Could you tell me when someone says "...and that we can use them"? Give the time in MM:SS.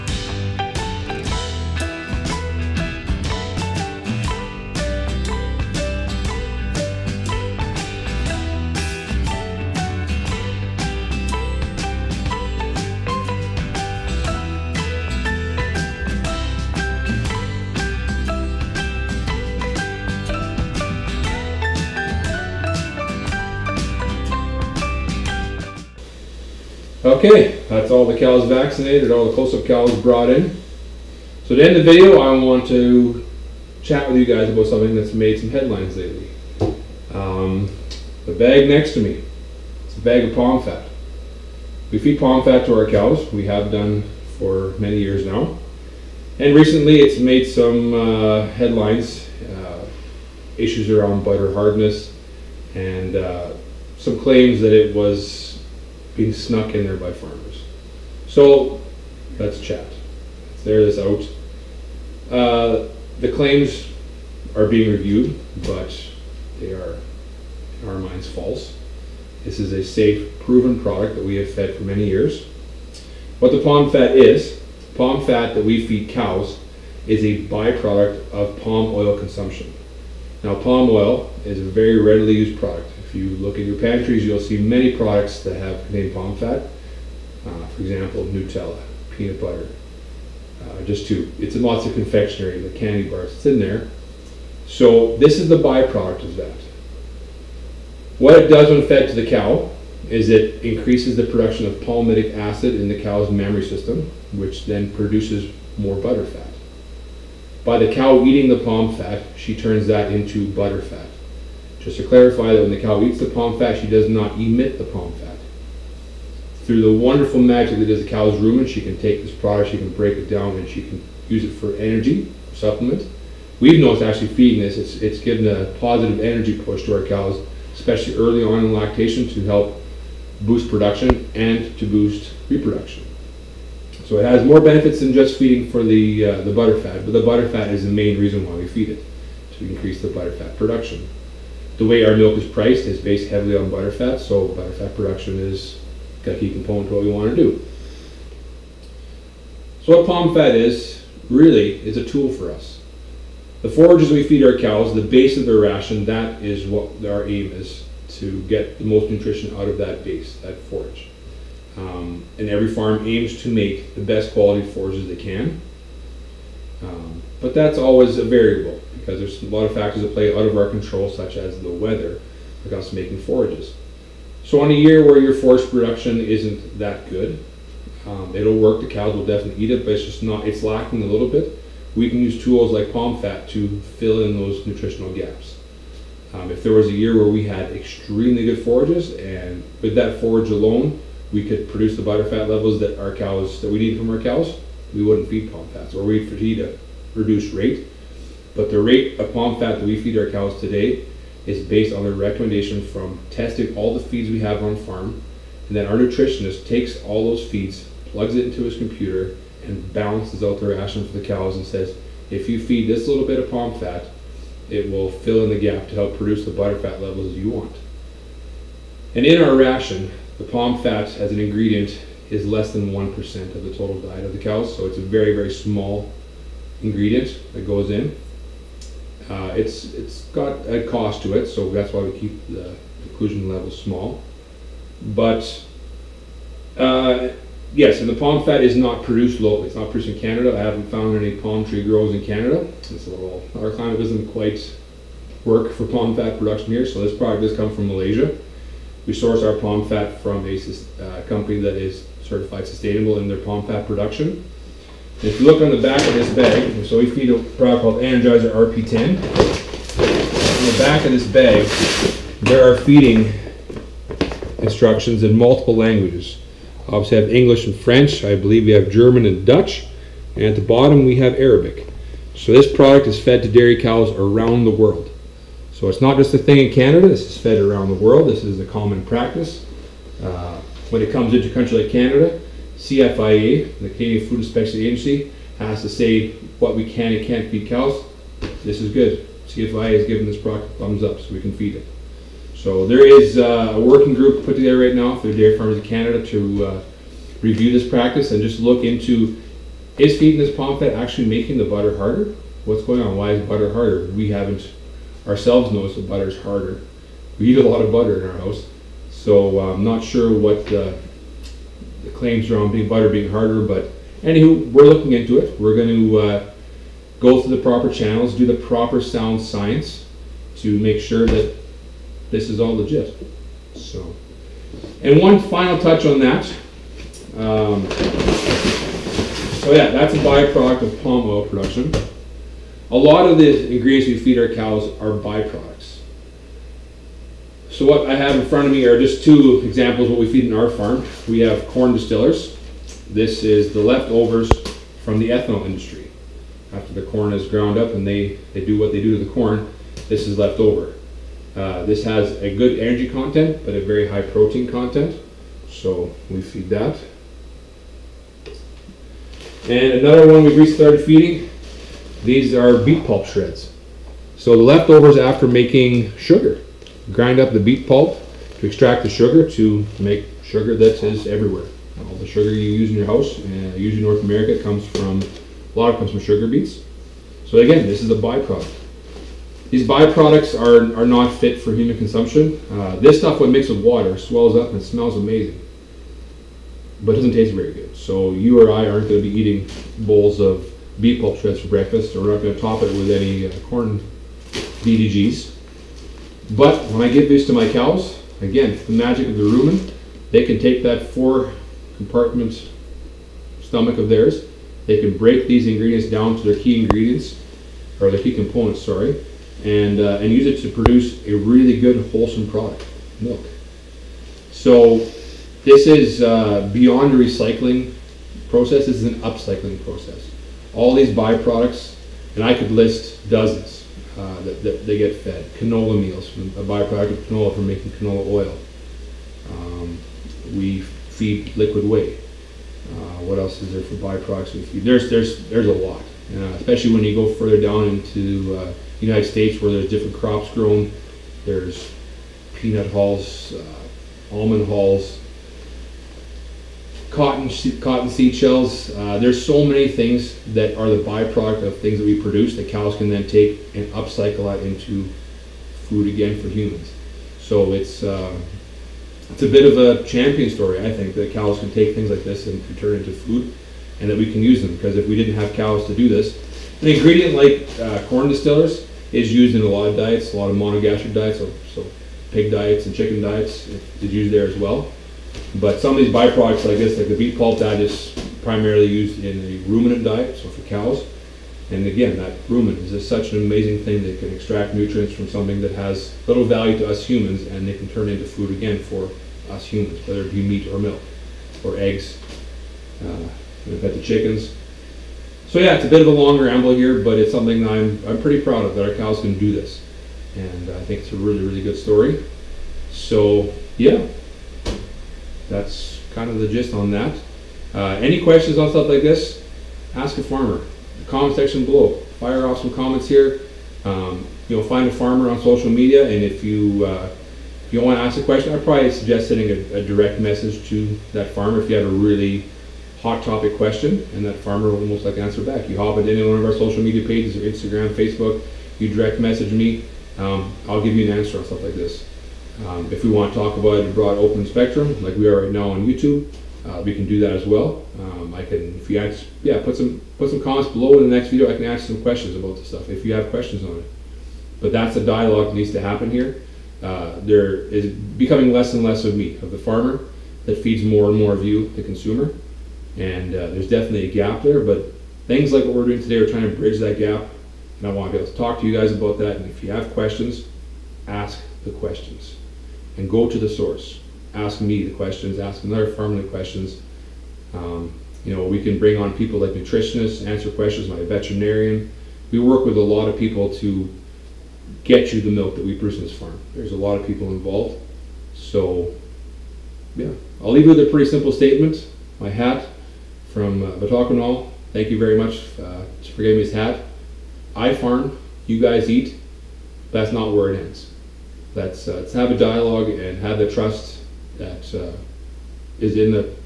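07:43.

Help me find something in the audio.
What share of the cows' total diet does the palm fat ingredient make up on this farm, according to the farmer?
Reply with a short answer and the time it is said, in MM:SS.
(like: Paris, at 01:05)
less than 1%, at 03:42.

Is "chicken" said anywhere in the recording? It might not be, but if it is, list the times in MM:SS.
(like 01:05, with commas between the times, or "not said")
07:52, 08:14.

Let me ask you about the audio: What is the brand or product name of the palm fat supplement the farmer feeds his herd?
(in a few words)
Energizer RP10.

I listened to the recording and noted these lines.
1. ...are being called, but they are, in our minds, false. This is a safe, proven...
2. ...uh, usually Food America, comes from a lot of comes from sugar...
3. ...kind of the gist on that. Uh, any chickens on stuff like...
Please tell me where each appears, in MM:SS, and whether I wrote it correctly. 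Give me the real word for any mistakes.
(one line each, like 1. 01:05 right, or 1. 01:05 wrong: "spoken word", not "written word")
1. 01:04 wrong: "reviewed", not "called"
2. 06:13 wrong: "North", not "Food"
3. 08:26 wrong: "questions", not "chickens".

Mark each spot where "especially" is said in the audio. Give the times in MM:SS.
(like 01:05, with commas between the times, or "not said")
02:07, 07:16.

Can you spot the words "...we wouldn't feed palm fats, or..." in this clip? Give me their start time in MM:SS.
03:14.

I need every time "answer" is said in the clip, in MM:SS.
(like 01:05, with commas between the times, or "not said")
08:45, 08:51, 09:30.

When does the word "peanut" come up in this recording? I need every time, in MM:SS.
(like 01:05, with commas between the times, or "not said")
01:29, 07:22.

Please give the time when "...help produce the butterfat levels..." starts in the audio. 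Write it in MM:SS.
03:35.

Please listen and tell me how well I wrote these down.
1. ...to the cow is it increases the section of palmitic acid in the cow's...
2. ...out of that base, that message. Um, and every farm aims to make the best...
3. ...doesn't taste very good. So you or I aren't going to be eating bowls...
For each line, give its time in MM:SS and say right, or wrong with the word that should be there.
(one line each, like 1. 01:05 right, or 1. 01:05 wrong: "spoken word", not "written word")
1. 01:39 wrong: "production", not "section"
2. 02:39 wrong: "forage", not "message"
3. 06:27 right.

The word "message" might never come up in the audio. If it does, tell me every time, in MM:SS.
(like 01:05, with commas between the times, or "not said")
08:40, 08:49.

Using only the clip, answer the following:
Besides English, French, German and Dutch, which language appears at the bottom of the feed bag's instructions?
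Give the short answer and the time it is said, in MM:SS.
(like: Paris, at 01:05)
Arabic, at 04:31.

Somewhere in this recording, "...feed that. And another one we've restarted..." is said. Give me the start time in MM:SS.
05:56.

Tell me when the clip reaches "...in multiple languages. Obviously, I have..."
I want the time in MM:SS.
04:25.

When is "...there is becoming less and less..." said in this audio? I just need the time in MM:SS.
09:07.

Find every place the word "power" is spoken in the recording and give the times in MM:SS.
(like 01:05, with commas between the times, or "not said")
not said.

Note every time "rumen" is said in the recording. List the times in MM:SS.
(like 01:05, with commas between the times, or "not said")
01:58, 06:39, 08:02.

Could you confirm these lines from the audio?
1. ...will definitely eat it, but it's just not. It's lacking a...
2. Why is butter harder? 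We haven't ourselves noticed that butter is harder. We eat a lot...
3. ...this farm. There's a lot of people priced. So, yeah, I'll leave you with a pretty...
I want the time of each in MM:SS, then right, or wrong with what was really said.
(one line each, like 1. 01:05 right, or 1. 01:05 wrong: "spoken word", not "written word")
1. 02:59 right
2. 05:03 right
3. 09:36 wrong: "involved", not "priced".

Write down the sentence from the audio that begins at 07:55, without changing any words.
But some of these byproducts like this, like the beet pulp, that is primarily used in the ruminant diet, so for cows.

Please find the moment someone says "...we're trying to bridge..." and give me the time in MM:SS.
09:16.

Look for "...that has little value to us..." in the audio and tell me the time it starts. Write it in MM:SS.
08:05.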